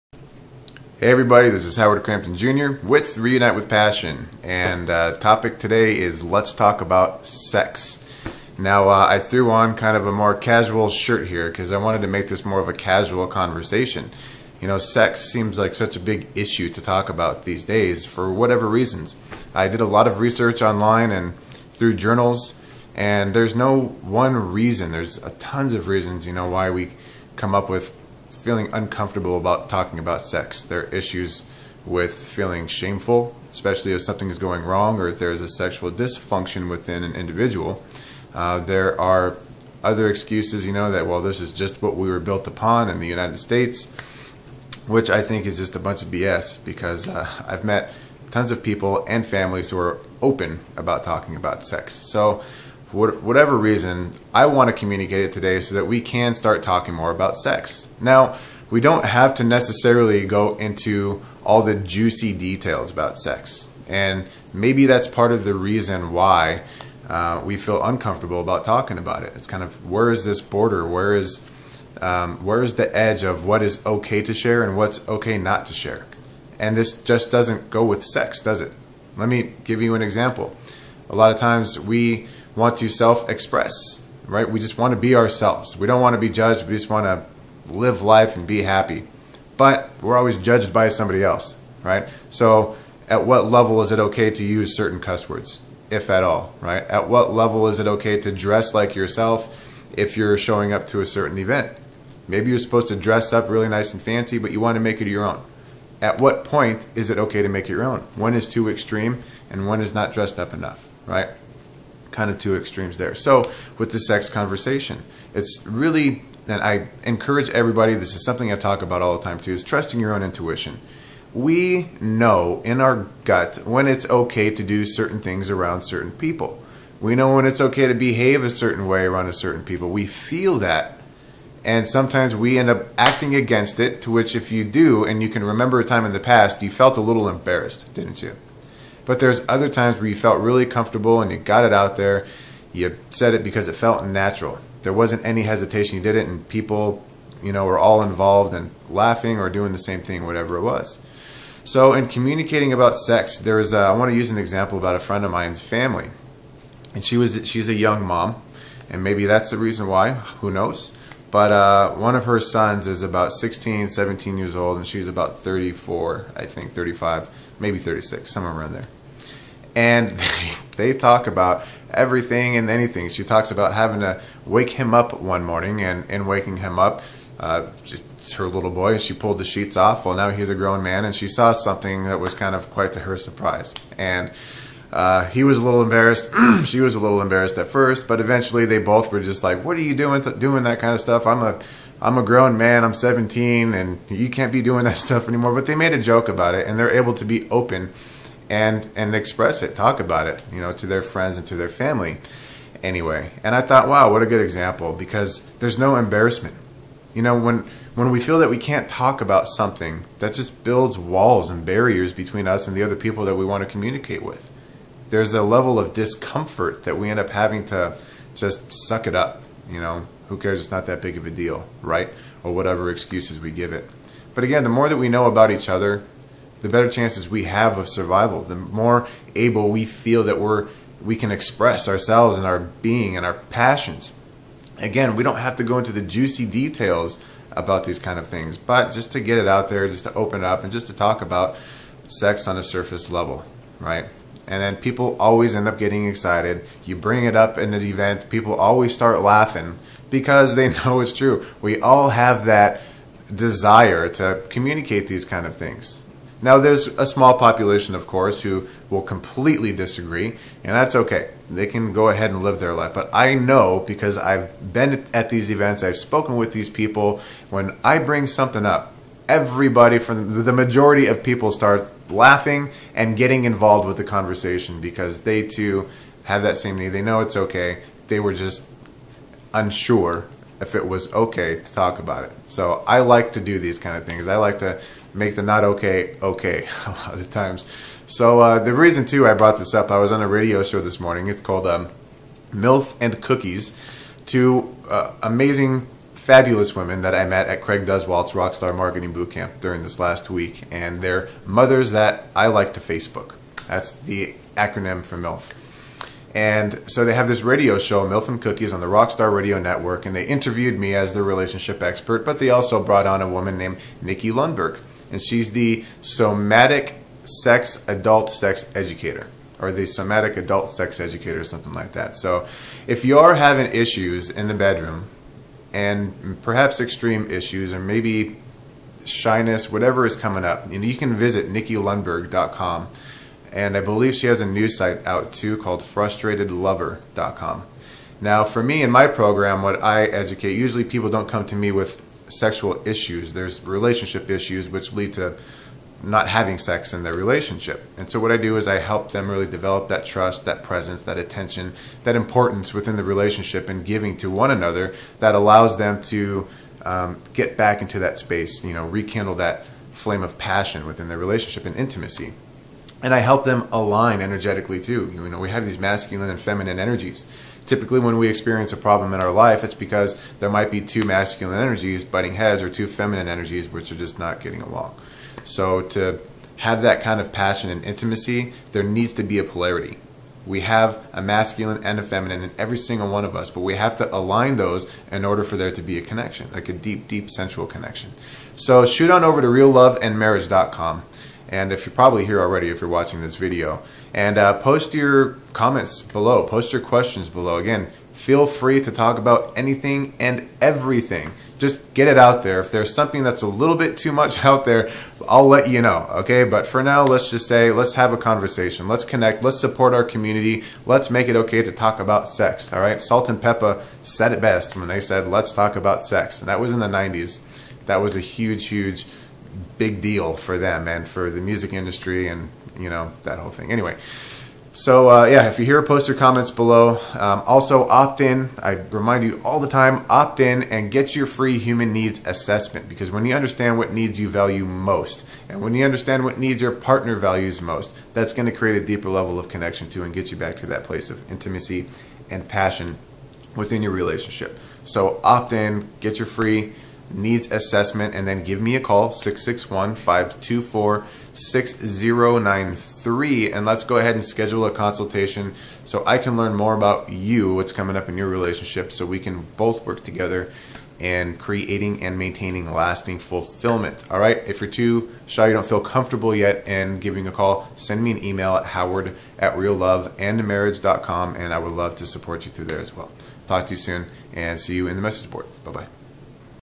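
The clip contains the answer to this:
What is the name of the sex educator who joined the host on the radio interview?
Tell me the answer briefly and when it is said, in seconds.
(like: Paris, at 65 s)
Nikki Lundberg, at 313 s.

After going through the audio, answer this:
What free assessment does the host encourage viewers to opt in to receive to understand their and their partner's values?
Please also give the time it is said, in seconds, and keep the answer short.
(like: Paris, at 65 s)
human needs assessment, at 431 s.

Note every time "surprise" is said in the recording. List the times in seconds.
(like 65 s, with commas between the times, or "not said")
183 s.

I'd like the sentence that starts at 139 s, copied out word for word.
But there's other times where you felt really comfortable and you got it out there.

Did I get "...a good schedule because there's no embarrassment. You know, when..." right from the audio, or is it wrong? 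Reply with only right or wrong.
wrong.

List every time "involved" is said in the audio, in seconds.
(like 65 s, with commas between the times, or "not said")
148 s, 273 s.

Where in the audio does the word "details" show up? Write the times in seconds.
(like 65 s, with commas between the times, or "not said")
62 s, 236 s.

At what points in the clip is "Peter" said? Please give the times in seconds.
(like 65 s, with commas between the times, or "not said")
not said.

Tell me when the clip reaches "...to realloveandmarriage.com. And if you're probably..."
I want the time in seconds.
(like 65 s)
389 s.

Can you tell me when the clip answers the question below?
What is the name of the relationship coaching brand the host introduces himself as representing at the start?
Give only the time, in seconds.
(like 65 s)
3 s.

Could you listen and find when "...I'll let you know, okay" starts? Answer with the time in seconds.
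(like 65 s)
405 s.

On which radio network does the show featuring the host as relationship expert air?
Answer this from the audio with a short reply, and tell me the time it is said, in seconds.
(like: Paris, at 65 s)
Rockstar Radio Network, at 308 s.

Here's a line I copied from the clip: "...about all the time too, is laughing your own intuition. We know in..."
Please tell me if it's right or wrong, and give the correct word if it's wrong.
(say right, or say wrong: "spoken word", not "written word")
wrong: "trusting", not "laughing".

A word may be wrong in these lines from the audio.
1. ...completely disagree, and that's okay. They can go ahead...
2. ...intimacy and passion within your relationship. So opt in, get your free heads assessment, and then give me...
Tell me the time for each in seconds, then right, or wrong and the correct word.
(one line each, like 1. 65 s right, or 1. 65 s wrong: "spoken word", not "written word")
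1. 259 s right
2. 441 s wrong: "needs", not "heads".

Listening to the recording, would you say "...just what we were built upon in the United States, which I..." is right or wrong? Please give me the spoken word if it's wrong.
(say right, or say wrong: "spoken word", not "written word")
right.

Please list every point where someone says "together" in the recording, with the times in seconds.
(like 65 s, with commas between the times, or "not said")
460 s.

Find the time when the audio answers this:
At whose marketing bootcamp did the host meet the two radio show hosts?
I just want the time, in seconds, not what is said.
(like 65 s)
297 s.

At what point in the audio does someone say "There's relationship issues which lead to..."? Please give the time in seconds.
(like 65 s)
343 s.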